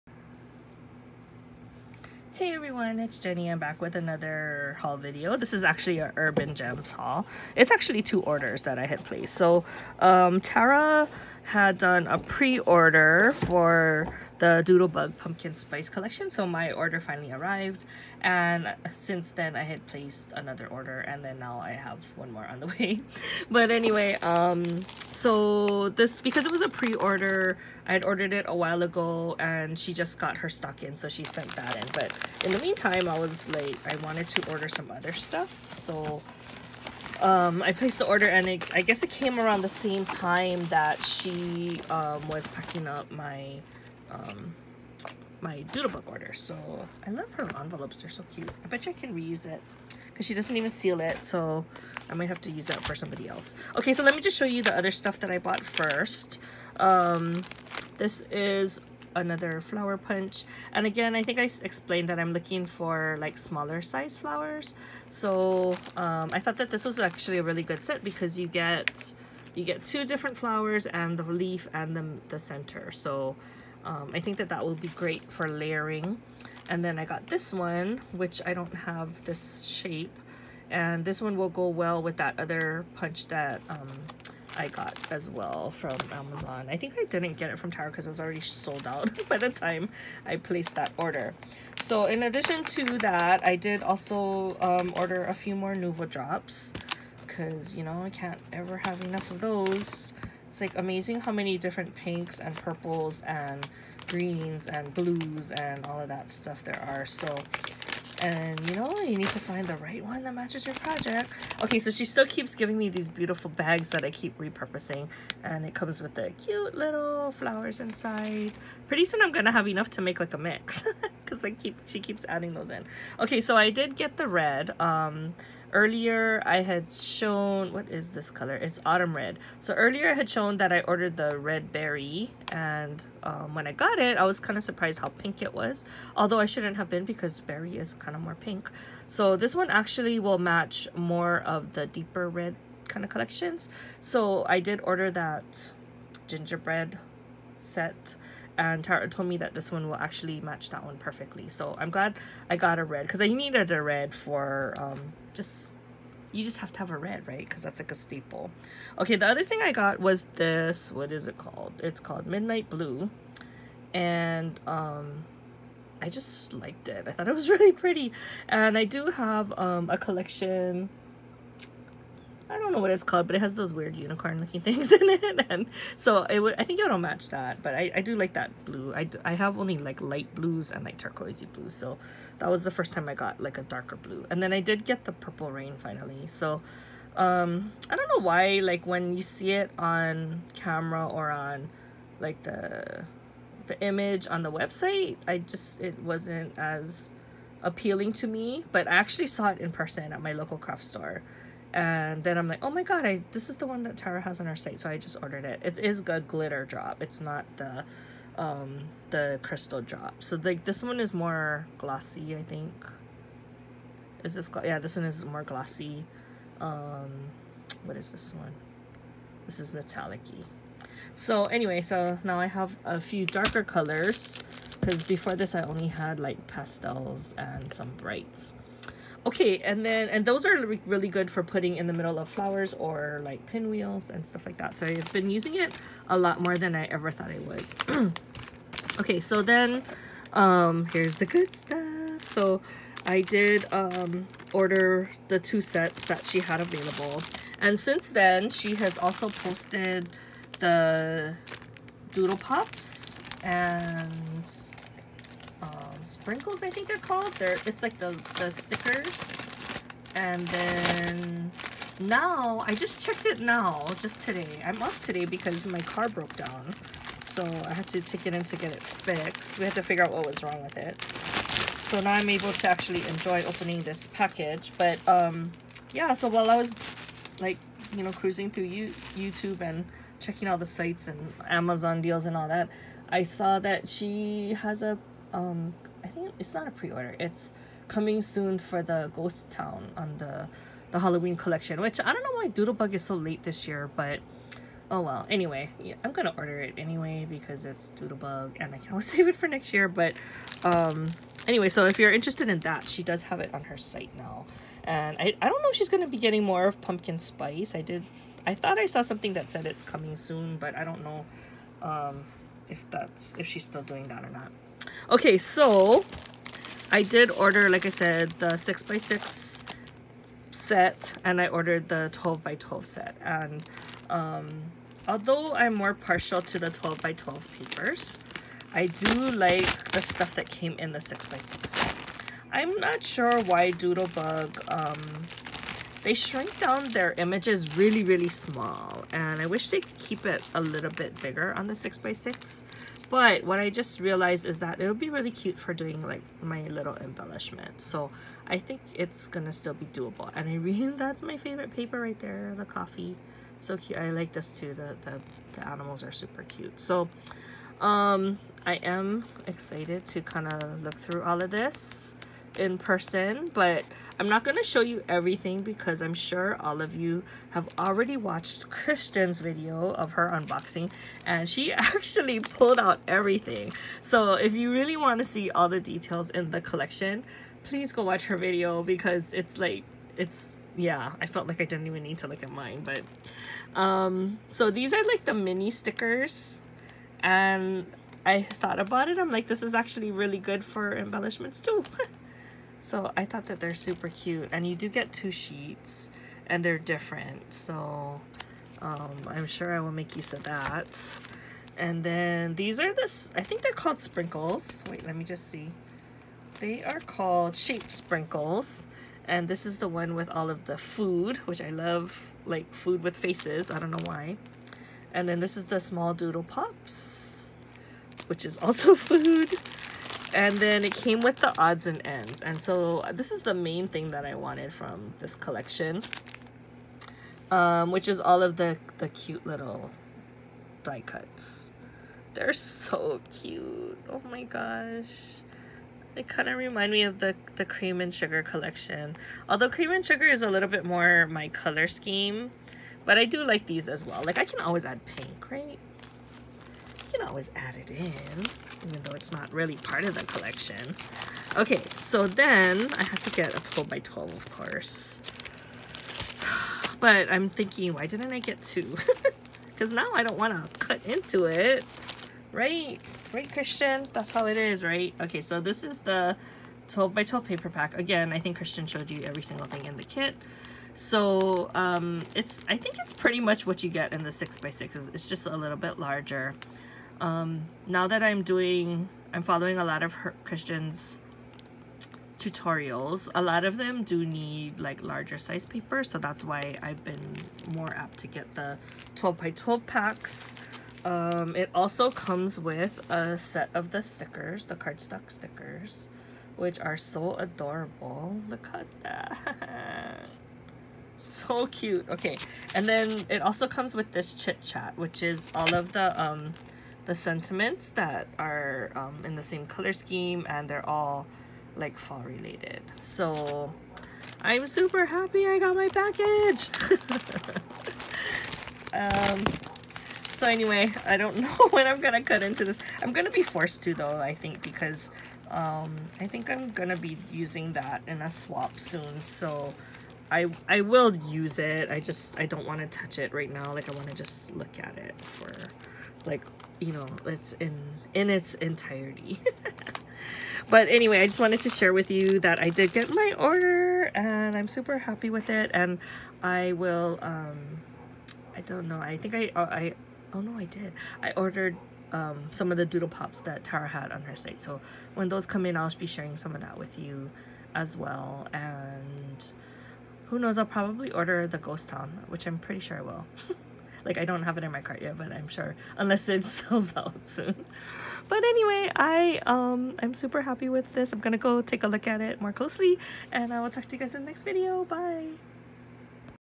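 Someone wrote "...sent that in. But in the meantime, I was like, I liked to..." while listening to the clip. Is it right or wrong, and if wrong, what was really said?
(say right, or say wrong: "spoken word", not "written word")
wrong: "wanted", not "liked".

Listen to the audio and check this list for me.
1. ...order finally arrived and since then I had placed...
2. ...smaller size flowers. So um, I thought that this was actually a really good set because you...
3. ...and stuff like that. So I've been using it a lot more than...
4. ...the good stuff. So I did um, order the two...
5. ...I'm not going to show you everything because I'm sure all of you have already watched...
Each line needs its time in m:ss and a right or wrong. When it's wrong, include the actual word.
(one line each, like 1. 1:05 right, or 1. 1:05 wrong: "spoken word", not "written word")
1. 0:16 right
2. 1:03 right
3. 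3:54 right
4. 4:01 right
5. 6:04 right.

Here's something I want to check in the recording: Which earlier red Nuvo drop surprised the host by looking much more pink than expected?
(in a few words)
Red Berry.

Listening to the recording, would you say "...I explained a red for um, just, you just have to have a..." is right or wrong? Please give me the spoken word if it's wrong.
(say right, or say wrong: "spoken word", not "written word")
wrong: "needed", not "explained".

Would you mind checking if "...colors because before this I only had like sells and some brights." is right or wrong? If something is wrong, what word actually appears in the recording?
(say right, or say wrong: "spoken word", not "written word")
wrong: "pastels", not "sells".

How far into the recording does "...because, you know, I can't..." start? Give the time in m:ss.
1:37.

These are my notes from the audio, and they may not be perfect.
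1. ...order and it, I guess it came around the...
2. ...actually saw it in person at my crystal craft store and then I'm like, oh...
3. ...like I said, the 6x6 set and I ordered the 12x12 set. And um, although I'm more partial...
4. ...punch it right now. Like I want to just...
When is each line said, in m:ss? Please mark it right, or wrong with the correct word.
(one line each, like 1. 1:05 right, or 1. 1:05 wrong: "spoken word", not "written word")
1. 0:38 right
2. 3:18 wrong: "local", not "crystal"
3. 5:17 right
4. 8:52 wrong: "touch", not "punch".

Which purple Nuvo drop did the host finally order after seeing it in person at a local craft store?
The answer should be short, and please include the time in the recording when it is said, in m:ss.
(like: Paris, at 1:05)
Purple Rain, at 3:05.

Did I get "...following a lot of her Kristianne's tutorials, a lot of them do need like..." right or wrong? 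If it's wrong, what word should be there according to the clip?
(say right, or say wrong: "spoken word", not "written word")
right.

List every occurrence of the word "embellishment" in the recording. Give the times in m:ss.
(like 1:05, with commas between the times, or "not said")
5:46, 6:30.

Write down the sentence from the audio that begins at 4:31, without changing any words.
So now I'm able to actually enjoy opening this package.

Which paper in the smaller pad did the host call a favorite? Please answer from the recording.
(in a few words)
the coffee.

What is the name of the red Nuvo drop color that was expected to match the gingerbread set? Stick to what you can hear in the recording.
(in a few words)
Autumn Red.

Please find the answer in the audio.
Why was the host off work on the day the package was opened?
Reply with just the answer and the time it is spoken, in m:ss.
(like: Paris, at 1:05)
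car broke down, at 4:25.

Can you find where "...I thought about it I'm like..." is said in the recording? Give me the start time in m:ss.
6:28.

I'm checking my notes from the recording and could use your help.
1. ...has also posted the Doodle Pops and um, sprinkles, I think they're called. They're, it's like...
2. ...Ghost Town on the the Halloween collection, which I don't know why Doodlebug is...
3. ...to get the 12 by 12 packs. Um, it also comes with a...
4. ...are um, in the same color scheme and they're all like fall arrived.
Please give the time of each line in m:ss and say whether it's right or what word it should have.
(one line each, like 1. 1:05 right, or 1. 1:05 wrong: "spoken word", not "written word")
1. 4:08 right
2. 4:49 right
3. 8:08 right
4. 8:28 wrong: "related", not "arrived".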